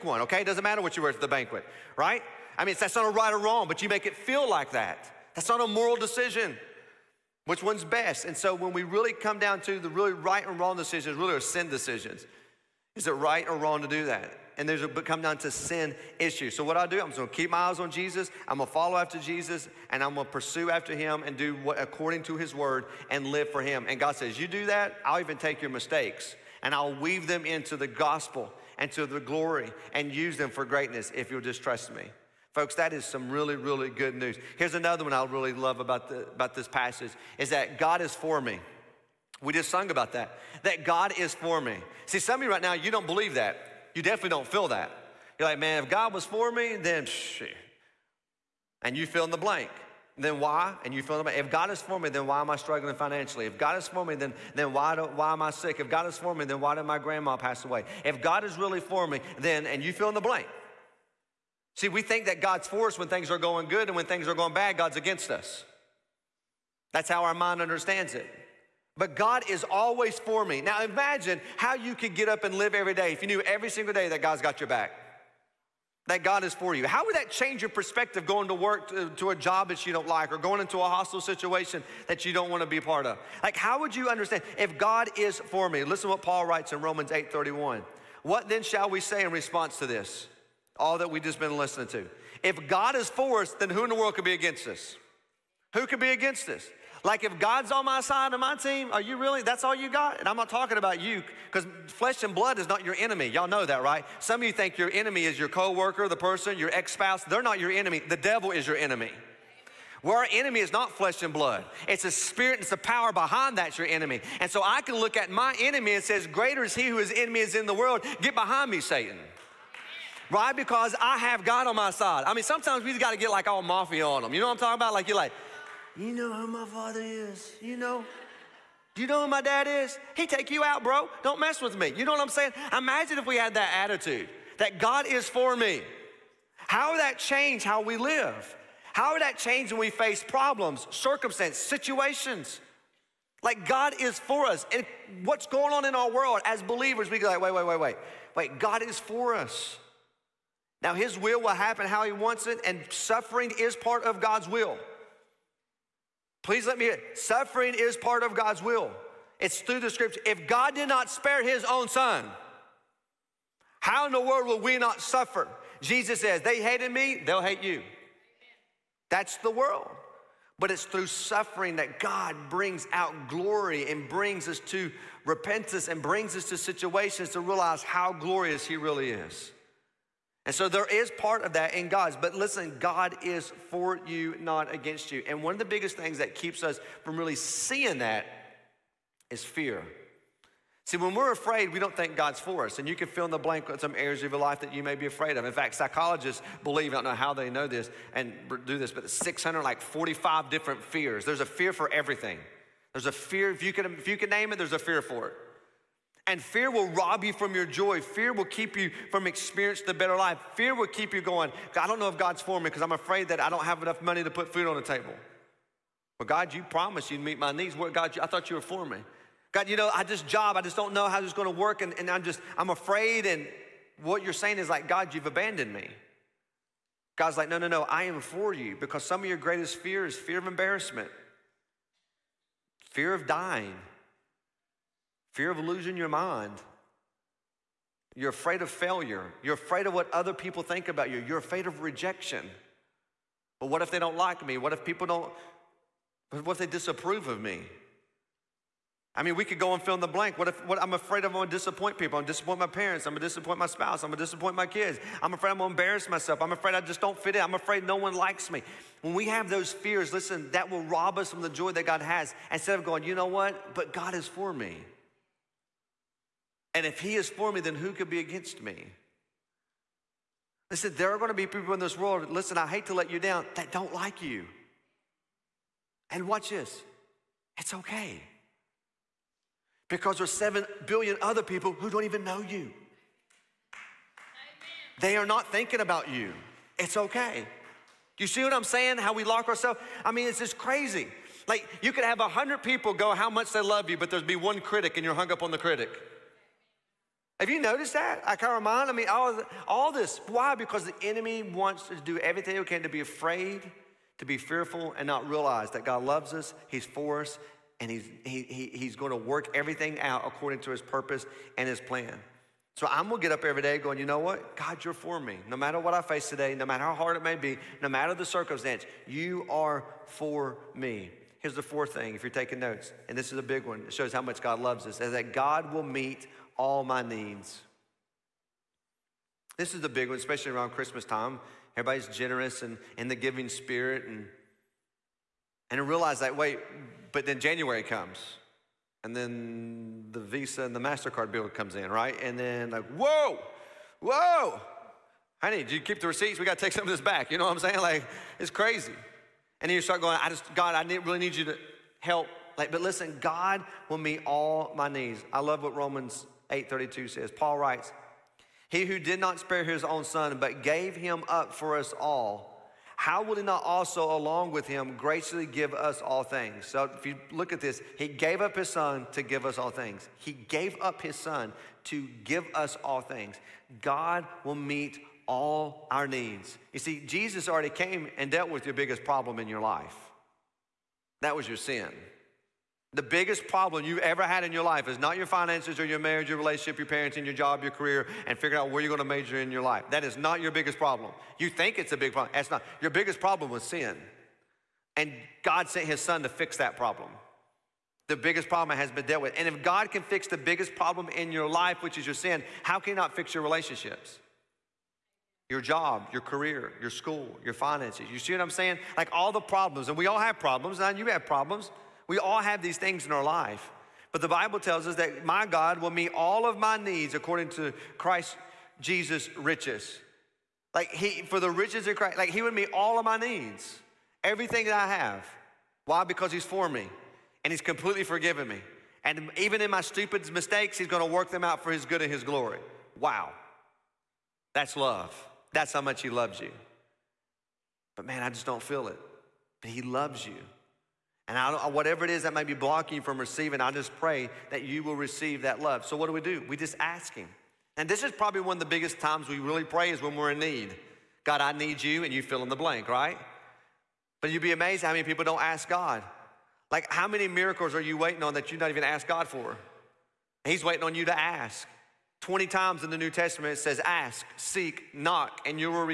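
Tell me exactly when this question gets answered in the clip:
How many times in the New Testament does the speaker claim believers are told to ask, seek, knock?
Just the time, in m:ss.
7:42.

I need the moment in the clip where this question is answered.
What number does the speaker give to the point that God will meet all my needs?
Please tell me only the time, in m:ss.
5:21.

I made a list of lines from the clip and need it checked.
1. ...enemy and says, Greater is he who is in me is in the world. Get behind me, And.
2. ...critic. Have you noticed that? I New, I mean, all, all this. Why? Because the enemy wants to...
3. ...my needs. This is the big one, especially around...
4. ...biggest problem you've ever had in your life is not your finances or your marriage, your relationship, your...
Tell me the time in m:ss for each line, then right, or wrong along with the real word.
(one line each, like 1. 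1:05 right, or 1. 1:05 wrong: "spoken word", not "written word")
1. 1:55 wrong: "Satan", not "And"
2. 4:55 wrong: "Akaramon", not "New"
3. 5:26 right
4. 6:23 right.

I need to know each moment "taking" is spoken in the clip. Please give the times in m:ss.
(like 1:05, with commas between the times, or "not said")
5:22.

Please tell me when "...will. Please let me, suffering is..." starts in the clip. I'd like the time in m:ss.
2:34.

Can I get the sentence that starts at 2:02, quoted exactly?
I mean, sometimes we just gotta get like all mafia on them.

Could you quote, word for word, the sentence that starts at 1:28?
What then shall we say in response to this?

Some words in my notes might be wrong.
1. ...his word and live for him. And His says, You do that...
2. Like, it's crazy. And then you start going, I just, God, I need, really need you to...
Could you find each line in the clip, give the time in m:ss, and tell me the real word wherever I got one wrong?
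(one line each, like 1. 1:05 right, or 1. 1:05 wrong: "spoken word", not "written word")
1. 0:22 wrong: "God", not "His"
2. 5:47 right.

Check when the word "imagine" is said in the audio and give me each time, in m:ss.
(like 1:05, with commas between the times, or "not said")
1:10, 2:12.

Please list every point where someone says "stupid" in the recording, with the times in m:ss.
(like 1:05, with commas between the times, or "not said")
7:09.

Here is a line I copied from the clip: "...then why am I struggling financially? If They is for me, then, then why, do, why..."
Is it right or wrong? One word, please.
wrong.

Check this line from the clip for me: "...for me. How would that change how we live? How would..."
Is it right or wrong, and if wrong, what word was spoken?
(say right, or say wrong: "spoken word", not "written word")
right.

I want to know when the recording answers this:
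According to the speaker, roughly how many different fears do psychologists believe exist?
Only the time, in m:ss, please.
3:19.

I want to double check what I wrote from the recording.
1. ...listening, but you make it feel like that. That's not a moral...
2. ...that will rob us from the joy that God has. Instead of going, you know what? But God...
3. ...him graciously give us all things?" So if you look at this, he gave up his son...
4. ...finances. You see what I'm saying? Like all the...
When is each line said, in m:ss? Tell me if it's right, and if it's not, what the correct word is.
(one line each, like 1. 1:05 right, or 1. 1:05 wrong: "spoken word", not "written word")
1. 0:03 wrong: "wrong", not "listening"
2. 4:20 right
3. 6:04 right
4. 6:47 right.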